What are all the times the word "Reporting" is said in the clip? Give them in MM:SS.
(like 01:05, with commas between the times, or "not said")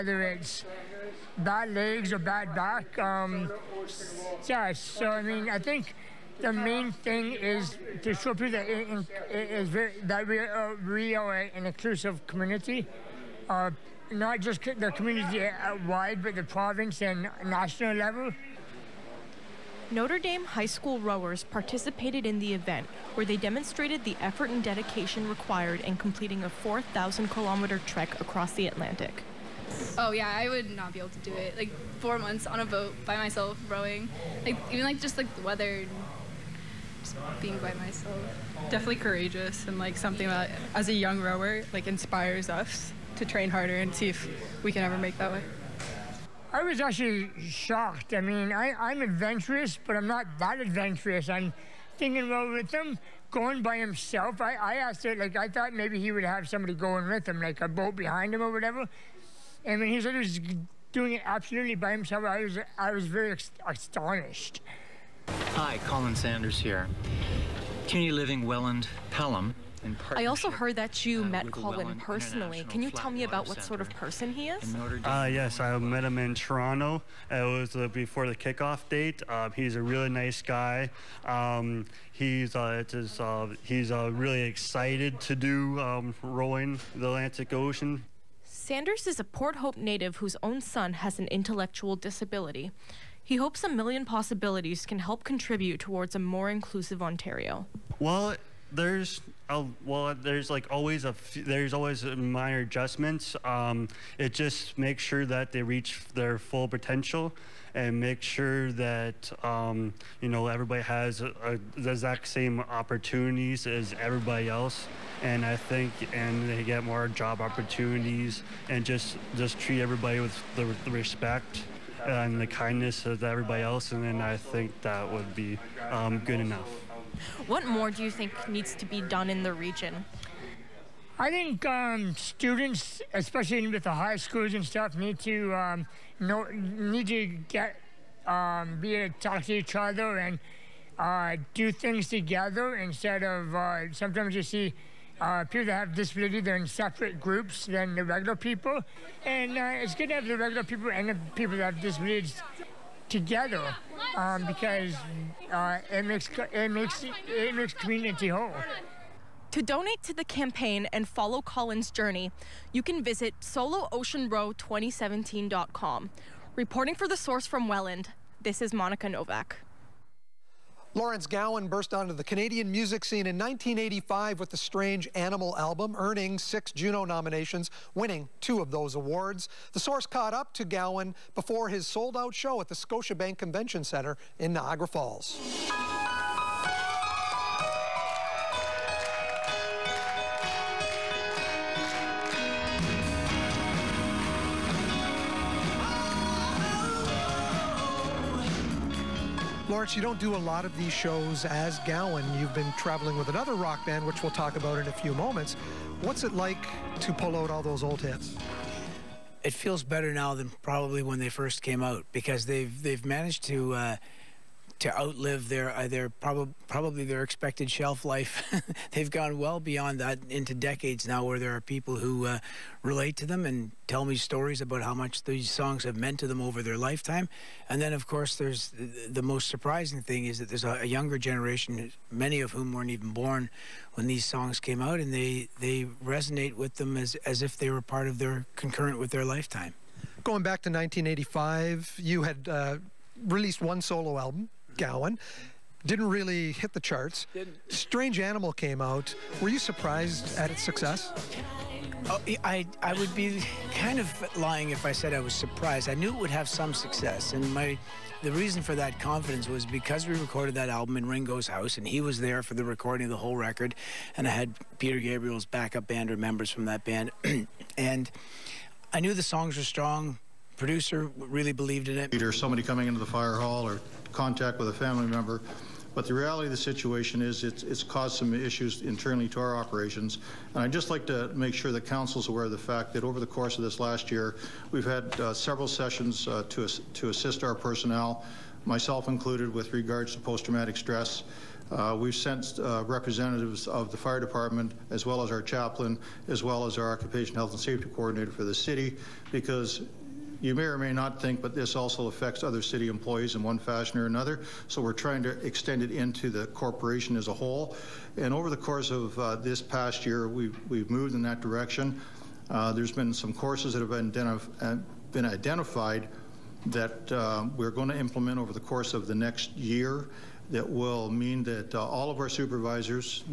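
02:46.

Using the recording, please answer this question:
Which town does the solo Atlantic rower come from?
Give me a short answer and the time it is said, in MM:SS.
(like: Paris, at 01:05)
Port Hope, at 01:29.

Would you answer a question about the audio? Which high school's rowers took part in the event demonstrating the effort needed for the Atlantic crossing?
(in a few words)
Notre Dame High School.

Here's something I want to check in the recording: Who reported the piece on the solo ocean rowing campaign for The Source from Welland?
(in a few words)
Monica Novak.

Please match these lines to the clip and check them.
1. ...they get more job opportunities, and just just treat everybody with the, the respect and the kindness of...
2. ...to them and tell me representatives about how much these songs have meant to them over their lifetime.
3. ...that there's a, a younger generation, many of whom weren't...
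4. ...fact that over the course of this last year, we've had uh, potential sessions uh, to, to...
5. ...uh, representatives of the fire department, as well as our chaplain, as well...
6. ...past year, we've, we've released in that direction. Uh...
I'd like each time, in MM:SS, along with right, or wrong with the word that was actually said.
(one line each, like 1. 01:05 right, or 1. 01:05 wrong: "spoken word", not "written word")
1. 01:56 right
2. 03:43 wrong: "stories", not "representatives"
3. 03:50 right
4. 04:42 wrong: "several", not "potential"
5. 04:52 right
6. 05:09 wrong: "moved", not "released".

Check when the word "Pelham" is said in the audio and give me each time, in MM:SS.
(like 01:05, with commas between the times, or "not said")
01:09.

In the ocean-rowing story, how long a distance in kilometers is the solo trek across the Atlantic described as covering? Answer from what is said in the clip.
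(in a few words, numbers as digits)
4,000 kilometers.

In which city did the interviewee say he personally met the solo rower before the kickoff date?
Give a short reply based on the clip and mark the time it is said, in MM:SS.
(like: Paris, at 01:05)
Toronto, at 01:16.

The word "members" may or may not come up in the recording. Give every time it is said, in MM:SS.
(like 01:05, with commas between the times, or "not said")
04:26, 04:35.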